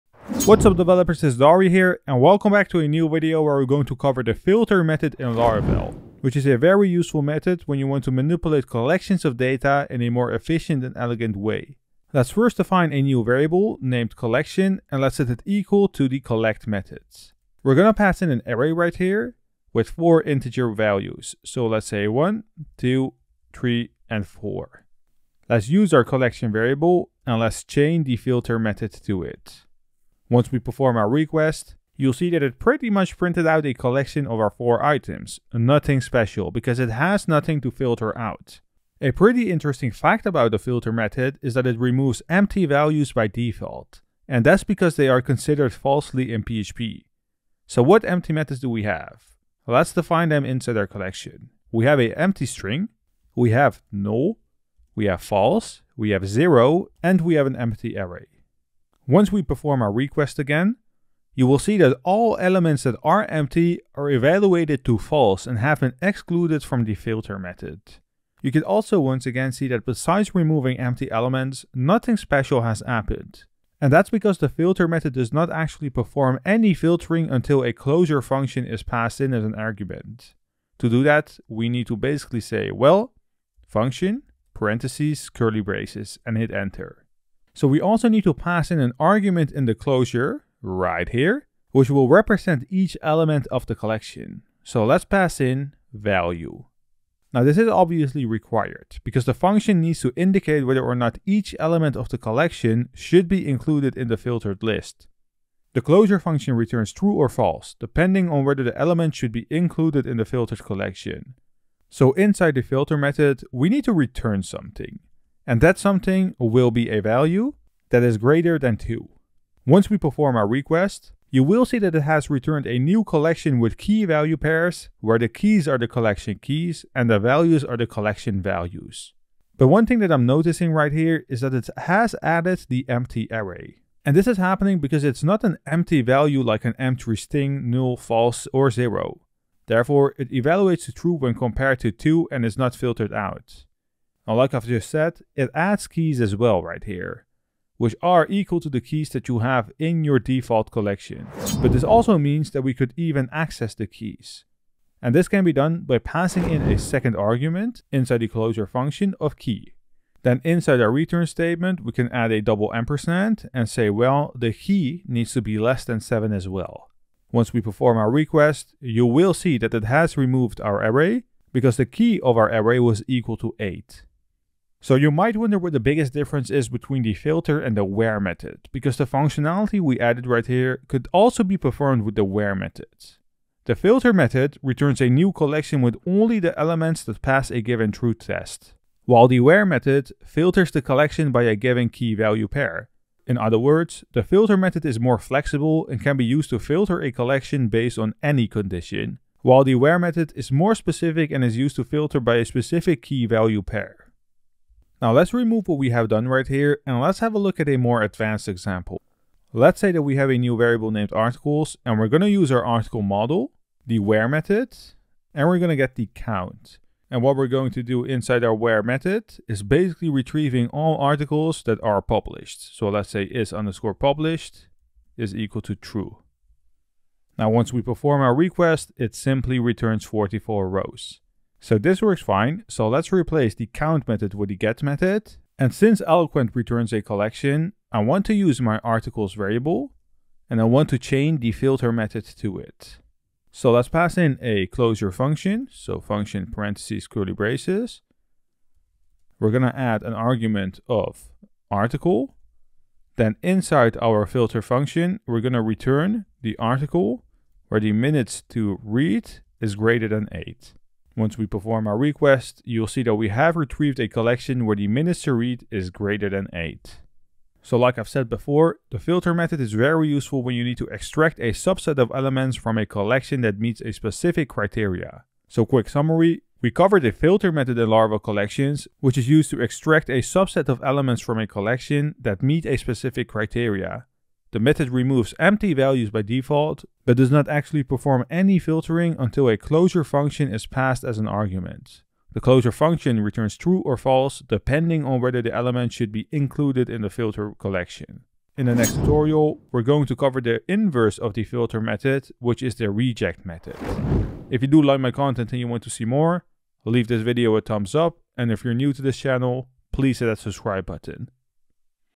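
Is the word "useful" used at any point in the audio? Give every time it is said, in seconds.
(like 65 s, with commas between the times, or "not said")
6 s, 270 s.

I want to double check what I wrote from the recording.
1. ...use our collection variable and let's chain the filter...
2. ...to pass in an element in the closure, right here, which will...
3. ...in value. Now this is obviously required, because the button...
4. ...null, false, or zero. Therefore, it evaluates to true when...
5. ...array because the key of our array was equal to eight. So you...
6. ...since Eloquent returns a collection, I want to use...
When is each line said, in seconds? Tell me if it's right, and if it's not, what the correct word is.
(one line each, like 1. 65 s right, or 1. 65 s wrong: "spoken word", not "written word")
1. 25 s right
2. 88 s wrong: "argument", not "element"
3. 95 s wrong: "function", not "button"
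4. 137 s right
5. 170 s right
6. 235 s right.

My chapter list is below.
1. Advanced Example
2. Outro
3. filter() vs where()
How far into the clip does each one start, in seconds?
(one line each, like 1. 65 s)
1. 205 s
2. 275 s
3. 174 s.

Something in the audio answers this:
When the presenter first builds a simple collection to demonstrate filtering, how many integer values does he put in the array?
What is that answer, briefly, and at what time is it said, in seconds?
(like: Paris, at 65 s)
4, at 19 s.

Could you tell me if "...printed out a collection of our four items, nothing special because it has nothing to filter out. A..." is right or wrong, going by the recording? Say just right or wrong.
right.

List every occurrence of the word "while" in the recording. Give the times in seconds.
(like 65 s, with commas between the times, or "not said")
189 s, 199 s.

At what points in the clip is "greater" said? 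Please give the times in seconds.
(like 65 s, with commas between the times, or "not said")
118 s, 259 s, 265 s.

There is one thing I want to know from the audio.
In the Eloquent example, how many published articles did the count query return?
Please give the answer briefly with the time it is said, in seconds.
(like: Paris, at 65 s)
44, at 230 s.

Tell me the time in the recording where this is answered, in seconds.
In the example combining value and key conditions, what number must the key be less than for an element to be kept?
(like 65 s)
165 s.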